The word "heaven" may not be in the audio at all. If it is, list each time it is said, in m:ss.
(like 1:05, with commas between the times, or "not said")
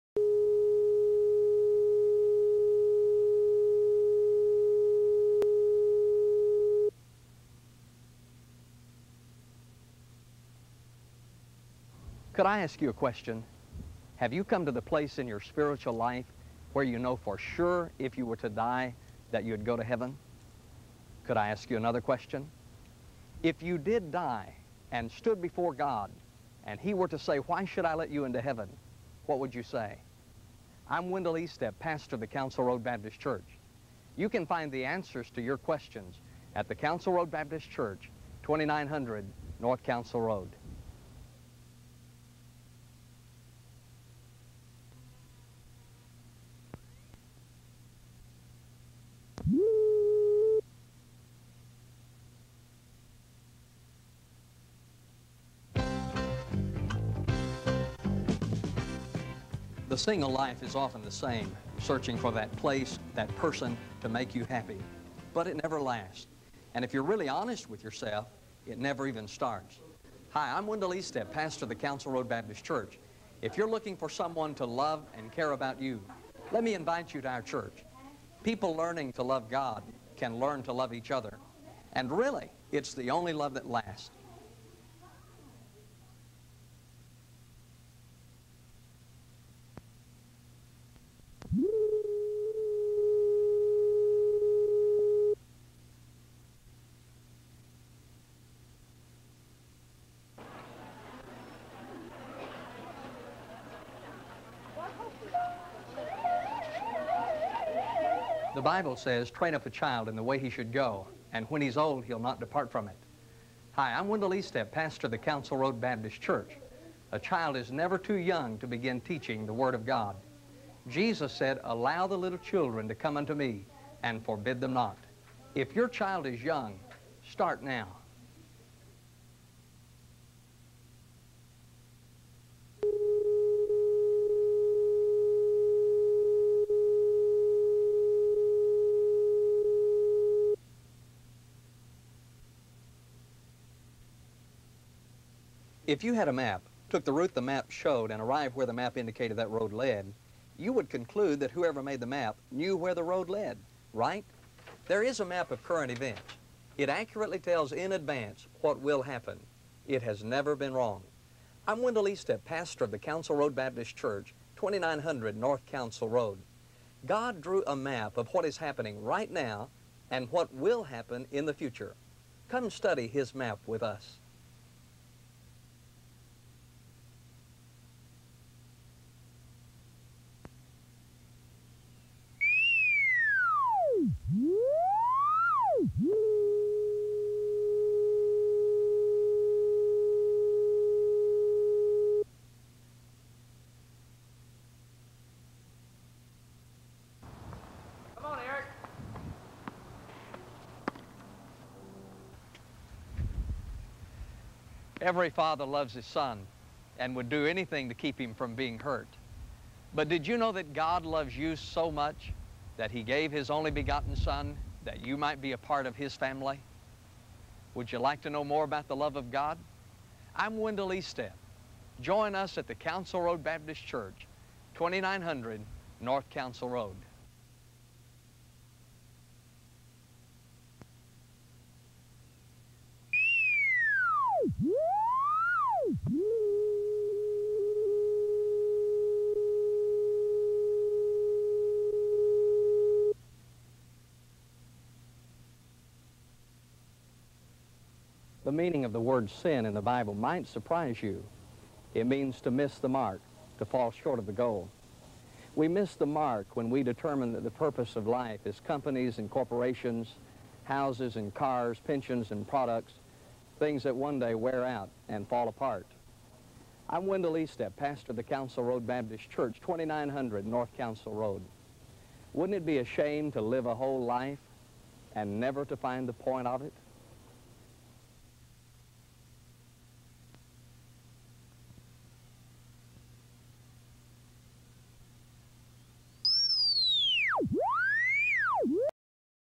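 0:19, 0:28.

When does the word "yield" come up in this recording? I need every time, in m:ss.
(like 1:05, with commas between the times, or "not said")
not said.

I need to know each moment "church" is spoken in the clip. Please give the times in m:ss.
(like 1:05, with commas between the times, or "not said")
0:33, 0:37, 1:12, 1:17, 1:56, 2:43, 3:43, 4:29.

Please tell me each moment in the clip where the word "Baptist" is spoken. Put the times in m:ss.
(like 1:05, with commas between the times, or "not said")
0:32, 0:37, 1:12, 1:55, 2:43, 3:43, 4:28.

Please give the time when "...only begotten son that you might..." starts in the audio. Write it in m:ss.
3:33.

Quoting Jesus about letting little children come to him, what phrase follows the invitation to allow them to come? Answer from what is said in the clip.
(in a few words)
forbid them not.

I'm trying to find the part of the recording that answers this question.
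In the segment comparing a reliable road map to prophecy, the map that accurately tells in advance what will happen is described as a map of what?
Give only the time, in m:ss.
2:35.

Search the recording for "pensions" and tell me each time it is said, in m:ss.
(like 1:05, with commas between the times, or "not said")
4:21.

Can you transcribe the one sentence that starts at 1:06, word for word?
And if you're really honest with yourself, it never even starts.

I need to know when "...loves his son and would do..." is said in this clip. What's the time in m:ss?
3:25.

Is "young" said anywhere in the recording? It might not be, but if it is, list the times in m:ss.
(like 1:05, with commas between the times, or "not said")
1:58, 2:06.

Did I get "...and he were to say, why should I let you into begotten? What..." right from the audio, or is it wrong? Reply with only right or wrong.
wrong.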